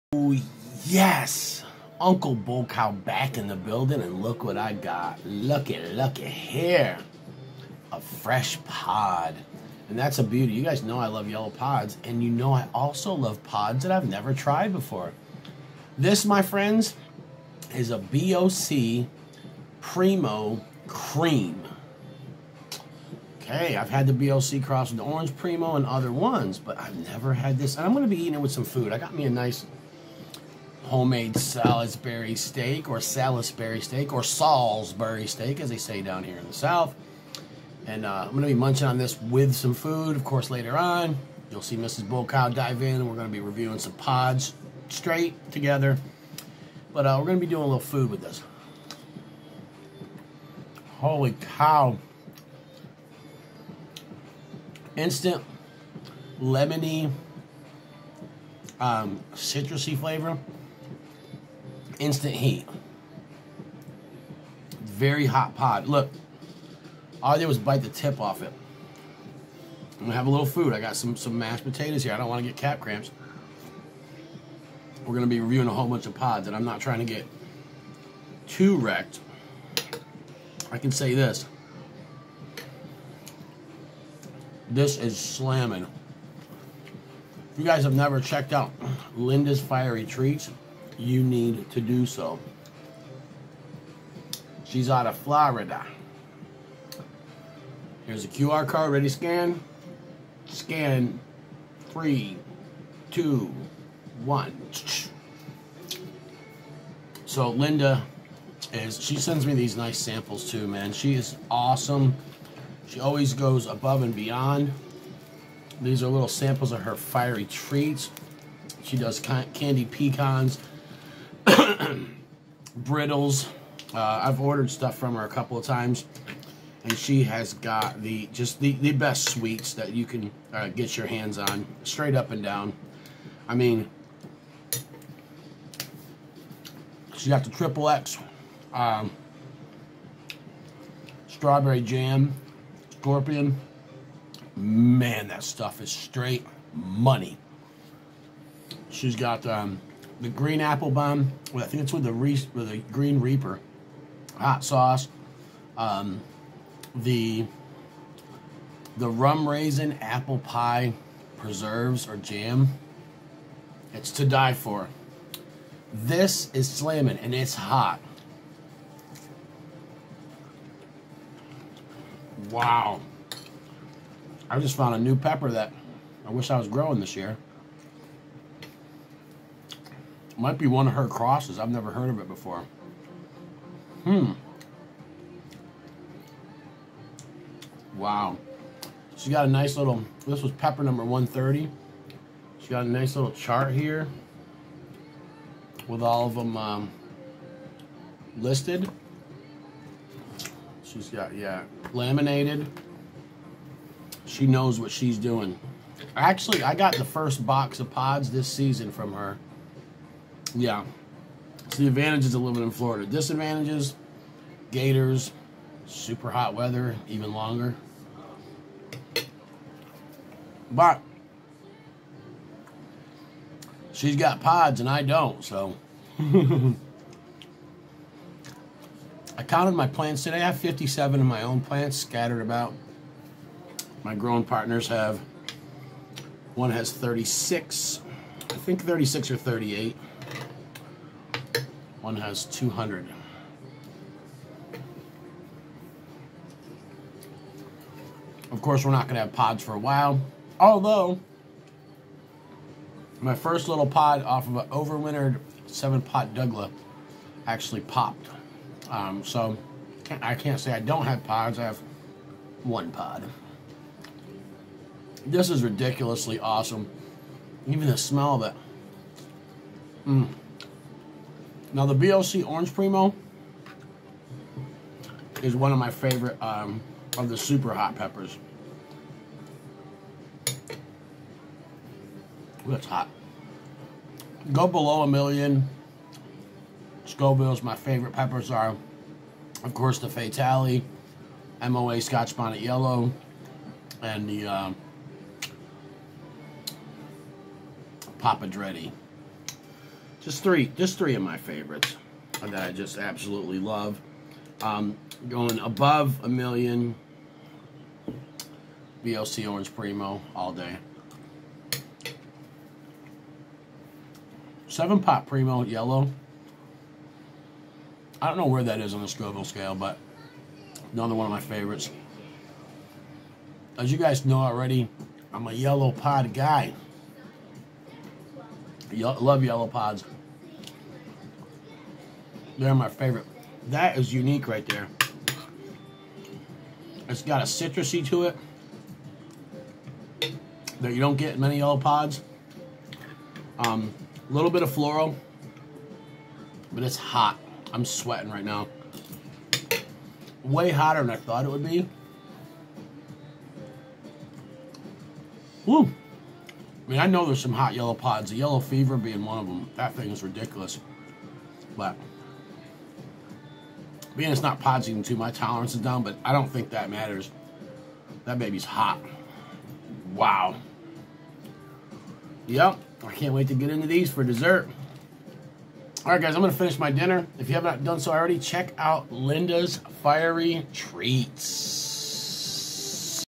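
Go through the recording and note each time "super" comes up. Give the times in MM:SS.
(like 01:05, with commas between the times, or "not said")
03:35, 04:37.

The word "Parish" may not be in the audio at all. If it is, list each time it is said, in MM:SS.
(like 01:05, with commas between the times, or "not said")
not said.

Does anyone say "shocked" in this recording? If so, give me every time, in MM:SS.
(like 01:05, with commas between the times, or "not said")
not said.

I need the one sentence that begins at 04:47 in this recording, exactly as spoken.
Scoville's my favorite peppers are, of course, the Fatalii, MOA Scotch Bonnet Yellow, and the uh, Papa Dreadie.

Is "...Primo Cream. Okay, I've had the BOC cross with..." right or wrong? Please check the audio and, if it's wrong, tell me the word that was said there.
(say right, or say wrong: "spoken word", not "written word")
right.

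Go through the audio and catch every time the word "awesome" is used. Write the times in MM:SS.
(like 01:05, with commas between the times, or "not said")
01:51, 04:26.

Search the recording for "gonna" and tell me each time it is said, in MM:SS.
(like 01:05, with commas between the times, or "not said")
01:10, 01:15.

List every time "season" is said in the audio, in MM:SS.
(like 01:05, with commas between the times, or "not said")
03:28, 06:04.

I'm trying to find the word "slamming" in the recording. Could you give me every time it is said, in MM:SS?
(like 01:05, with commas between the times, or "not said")
01:25, 02:46.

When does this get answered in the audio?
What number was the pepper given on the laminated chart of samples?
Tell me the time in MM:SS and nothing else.
03:11.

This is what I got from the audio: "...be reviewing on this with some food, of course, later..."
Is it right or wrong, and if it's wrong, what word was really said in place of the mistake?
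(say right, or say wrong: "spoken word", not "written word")
wrong: "munching", not "reviewing".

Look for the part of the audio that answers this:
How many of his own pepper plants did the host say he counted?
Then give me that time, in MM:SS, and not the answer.
03:50.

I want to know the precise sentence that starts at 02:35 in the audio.
Um, the the rum raisin apple pie preserves or jam.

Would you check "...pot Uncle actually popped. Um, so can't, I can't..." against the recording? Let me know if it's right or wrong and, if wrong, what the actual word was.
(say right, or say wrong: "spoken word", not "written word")
wrong: "Douglah", not "Uncle".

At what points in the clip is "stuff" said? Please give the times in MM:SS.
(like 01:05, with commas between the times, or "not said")
02:04, 02:25.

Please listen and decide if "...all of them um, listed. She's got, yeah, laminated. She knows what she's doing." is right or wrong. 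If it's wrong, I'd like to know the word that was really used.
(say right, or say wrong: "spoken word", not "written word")
right.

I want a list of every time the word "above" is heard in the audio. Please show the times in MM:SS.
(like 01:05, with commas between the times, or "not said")
01:53, 05:05.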